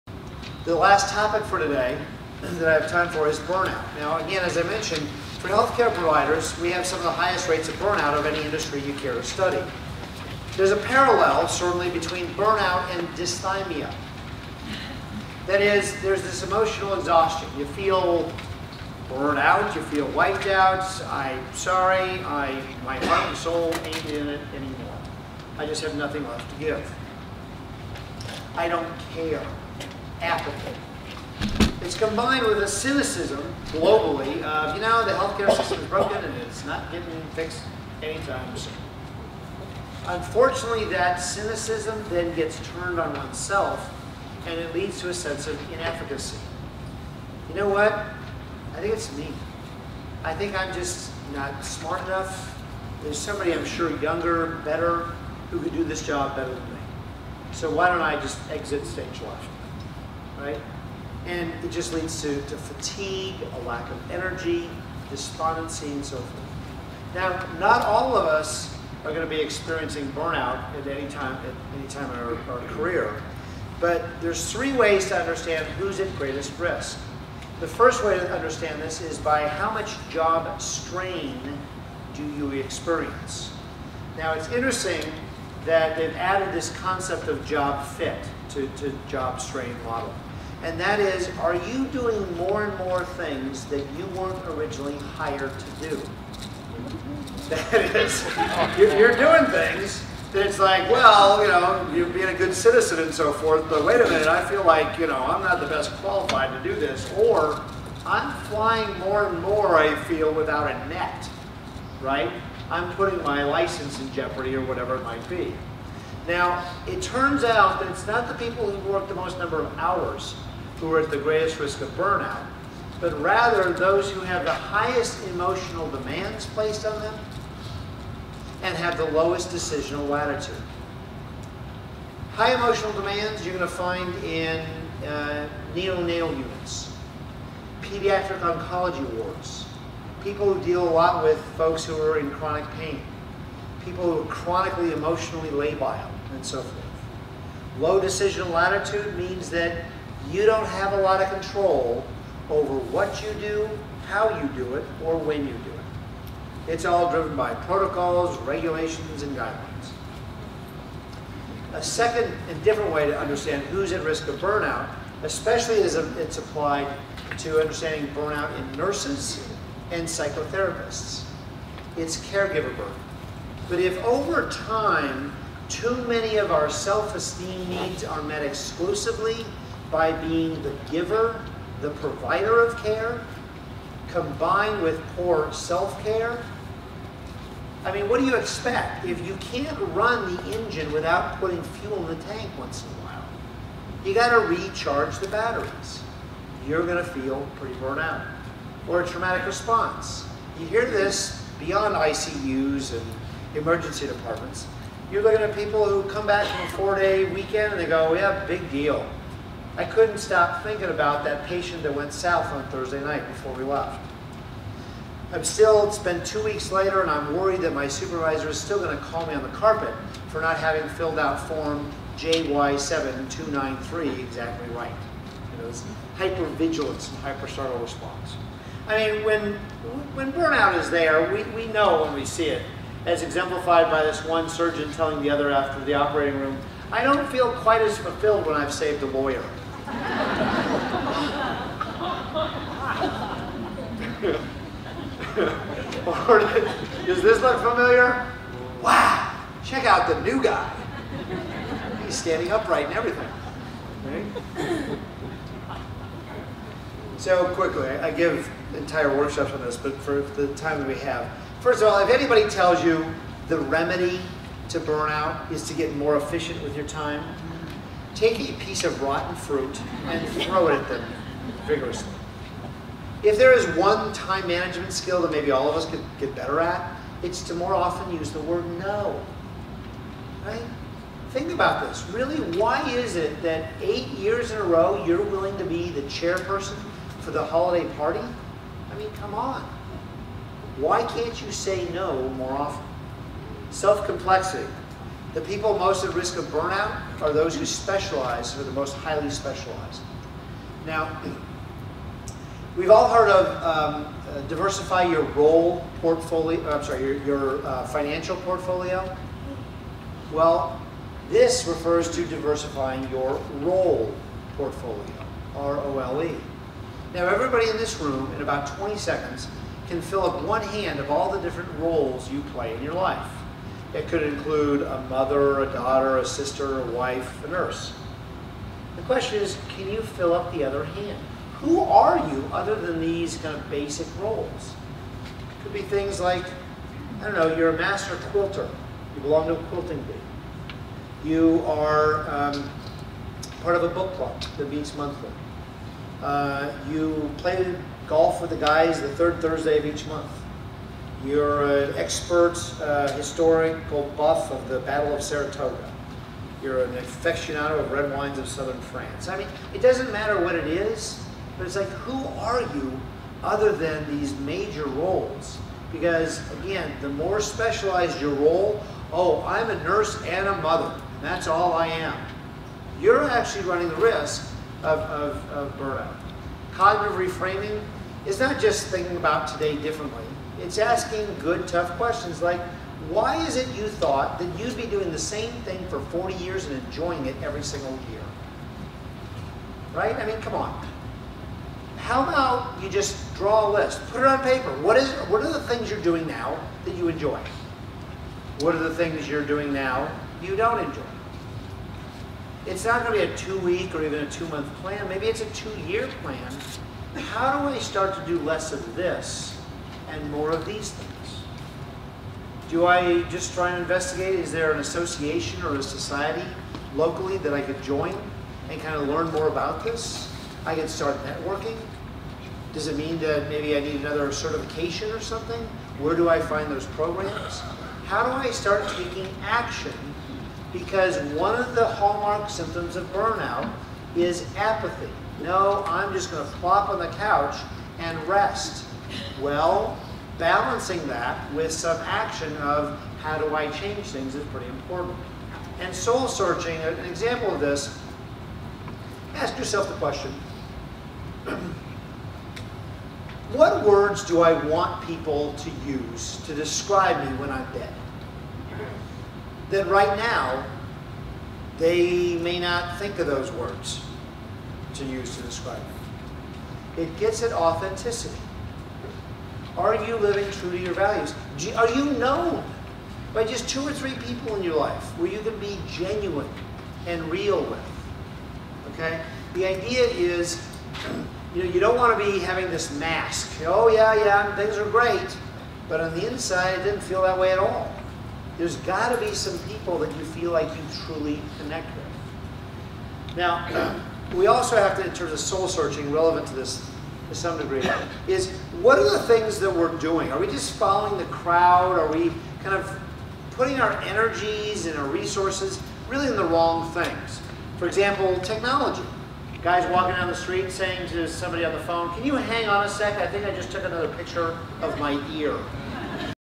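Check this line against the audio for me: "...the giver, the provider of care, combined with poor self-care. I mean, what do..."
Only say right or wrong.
right.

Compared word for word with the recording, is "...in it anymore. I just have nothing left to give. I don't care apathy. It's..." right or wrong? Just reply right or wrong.
right.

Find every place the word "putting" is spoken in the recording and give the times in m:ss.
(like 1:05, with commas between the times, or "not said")
1:52, 3:11, 8:23.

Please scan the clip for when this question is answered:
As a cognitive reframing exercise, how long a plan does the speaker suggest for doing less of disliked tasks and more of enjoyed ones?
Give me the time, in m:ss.
6:45.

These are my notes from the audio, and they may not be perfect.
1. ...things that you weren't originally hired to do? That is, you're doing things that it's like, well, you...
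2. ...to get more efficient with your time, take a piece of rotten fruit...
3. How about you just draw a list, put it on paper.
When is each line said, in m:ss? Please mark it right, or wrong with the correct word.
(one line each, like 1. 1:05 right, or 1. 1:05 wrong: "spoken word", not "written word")
1. 1:33 right
2. 4:25 right
3. 6:31 right.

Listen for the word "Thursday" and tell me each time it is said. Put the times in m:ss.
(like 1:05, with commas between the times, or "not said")
3:32, 5:49.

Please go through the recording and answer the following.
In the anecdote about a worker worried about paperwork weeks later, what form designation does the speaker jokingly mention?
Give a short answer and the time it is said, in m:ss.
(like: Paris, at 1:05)
JY7293, at 3:41.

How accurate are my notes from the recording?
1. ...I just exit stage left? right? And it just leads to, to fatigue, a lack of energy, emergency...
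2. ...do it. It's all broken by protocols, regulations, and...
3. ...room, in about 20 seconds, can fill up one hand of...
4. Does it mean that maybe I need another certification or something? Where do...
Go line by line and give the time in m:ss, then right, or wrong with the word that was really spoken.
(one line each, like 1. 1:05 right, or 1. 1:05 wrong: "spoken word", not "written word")
1. 0:58 wrong: "despondency", not "emergency"
2. 2:35 wrong: "driven", not "broken"
3. 5:18 right
4. 7:02 right.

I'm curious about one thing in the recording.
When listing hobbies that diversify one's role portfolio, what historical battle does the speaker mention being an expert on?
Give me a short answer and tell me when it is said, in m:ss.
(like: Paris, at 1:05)
Battle of Saratoga, at 5:54.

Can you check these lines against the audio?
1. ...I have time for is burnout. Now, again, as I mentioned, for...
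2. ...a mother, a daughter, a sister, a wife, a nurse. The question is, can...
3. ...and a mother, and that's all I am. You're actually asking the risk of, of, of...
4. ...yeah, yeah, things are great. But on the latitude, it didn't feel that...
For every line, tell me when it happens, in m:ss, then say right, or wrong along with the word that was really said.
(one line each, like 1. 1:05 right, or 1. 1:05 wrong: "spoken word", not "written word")
1. 0:02 right
2. 5:24 right
3. 6:10 wrong: "running", not "asking"
4. 8:03 wrong: "inside", not "latitude".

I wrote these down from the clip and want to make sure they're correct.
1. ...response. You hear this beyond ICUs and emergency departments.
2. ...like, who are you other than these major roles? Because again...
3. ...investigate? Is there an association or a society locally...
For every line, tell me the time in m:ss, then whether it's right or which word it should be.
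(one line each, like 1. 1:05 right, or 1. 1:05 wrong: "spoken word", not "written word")
1. 3:19 right
2. 6:01 right
3. 6:53 right.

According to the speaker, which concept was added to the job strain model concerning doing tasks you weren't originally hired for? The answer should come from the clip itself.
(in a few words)
job fit.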